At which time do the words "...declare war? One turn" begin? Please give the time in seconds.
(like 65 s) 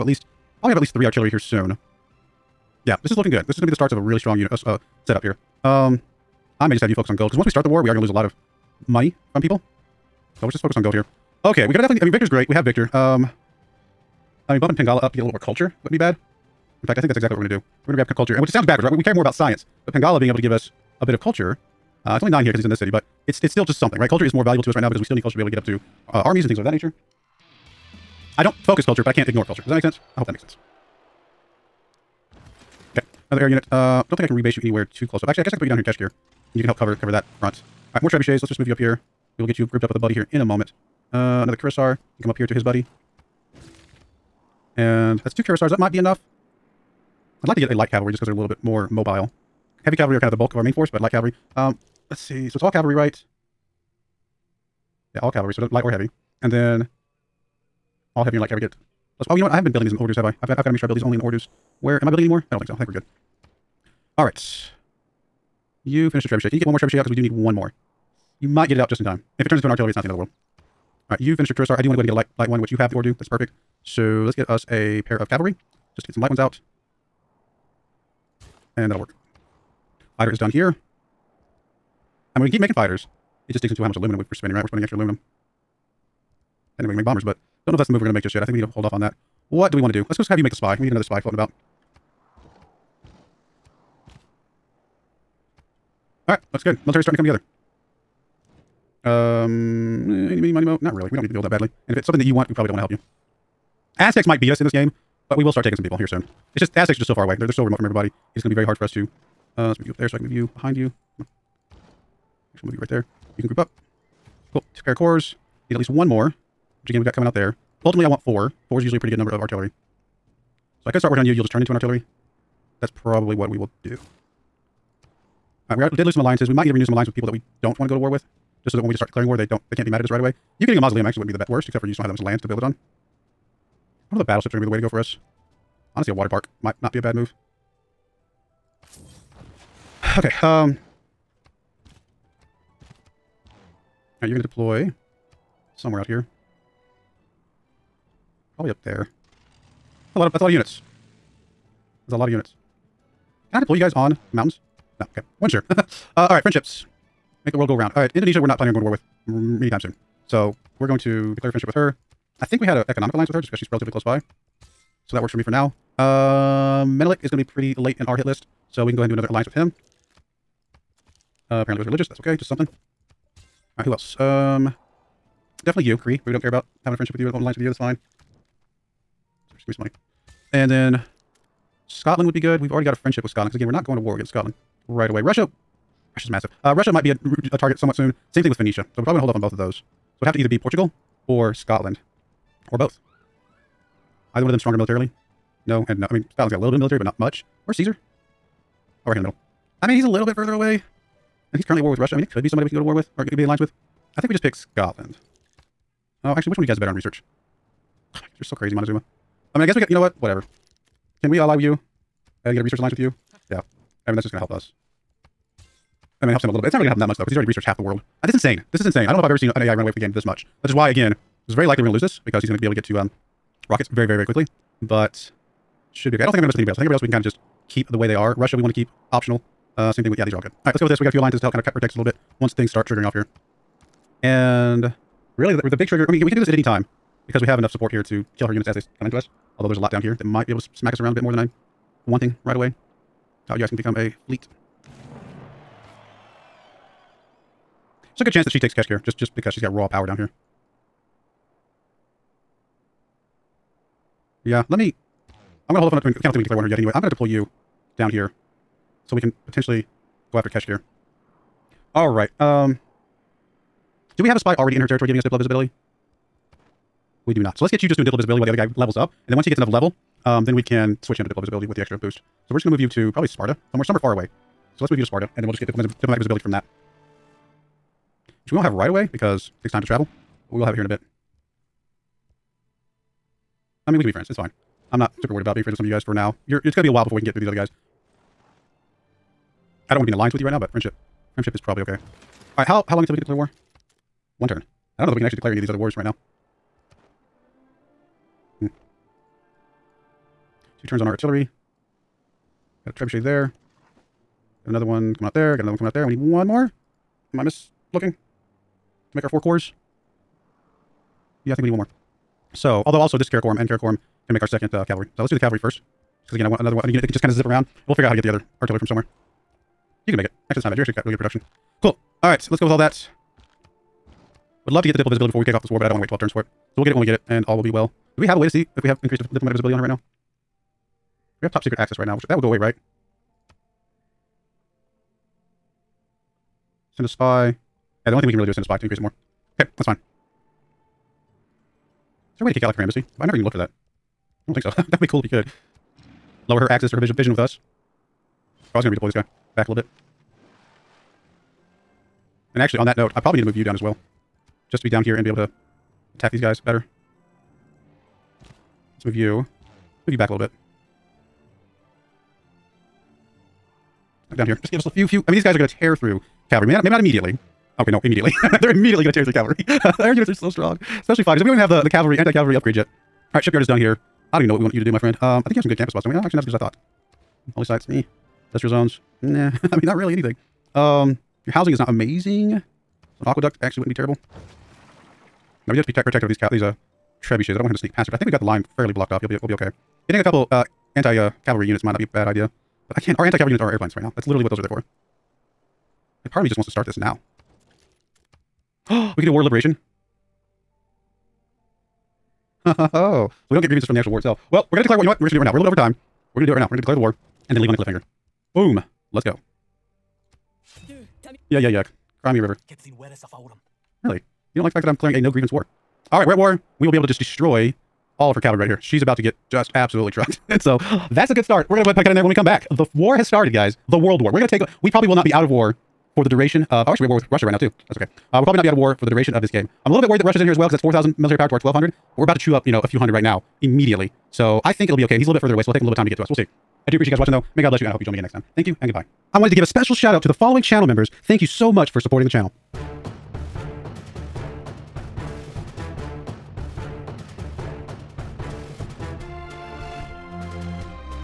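293 s.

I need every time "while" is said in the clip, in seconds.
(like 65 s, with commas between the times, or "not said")
268 s, 286 s.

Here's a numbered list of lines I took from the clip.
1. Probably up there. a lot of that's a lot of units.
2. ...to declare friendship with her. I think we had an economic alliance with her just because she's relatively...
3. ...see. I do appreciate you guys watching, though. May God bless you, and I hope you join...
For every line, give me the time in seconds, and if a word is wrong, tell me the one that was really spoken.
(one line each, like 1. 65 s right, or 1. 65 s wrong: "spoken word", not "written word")
1. 148 s right
2. 160 s right
3. 436 s right.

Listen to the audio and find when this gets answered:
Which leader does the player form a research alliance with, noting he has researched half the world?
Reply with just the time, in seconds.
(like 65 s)
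208 s.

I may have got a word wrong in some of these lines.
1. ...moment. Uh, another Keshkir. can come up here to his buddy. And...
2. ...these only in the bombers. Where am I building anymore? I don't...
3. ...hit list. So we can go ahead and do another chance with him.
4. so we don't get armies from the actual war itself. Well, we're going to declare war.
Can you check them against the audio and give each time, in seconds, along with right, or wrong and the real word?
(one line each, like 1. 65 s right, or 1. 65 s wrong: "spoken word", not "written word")
1. 40 s wrong: "Cuirassier", not "Keshkir"
2. 60 s wrong: "orders", not "bombers"
3. 168 s wrong: "alliance", not "chance"
4. 403 s wrong: "grievances", not "armies".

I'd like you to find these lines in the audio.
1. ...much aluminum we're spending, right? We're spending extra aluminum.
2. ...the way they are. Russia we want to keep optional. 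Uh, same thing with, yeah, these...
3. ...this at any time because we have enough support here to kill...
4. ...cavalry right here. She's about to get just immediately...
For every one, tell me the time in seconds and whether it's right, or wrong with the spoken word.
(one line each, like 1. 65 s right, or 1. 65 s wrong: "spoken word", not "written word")
1. 83 s right
2. 227 s right
3. 236 s right
4. 418 s wrong: "absolutely", not "immediately".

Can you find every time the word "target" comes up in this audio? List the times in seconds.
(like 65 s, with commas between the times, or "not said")
187 s.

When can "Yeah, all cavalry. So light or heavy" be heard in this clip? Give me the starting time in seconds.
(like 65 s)
55 s.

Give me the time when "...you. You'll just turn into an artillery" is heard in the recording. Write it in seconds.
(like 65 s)
121 s.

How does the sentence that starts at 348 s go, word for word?
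Oh, I was going to redeploy this guy back a little bit.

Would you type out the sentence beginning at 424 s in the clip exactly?
We probably will not be out of war for the duration of...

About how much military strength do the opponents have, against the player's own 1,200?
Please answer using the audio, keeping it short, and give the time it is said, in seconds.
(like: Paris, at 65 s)
4,000, at 430 s.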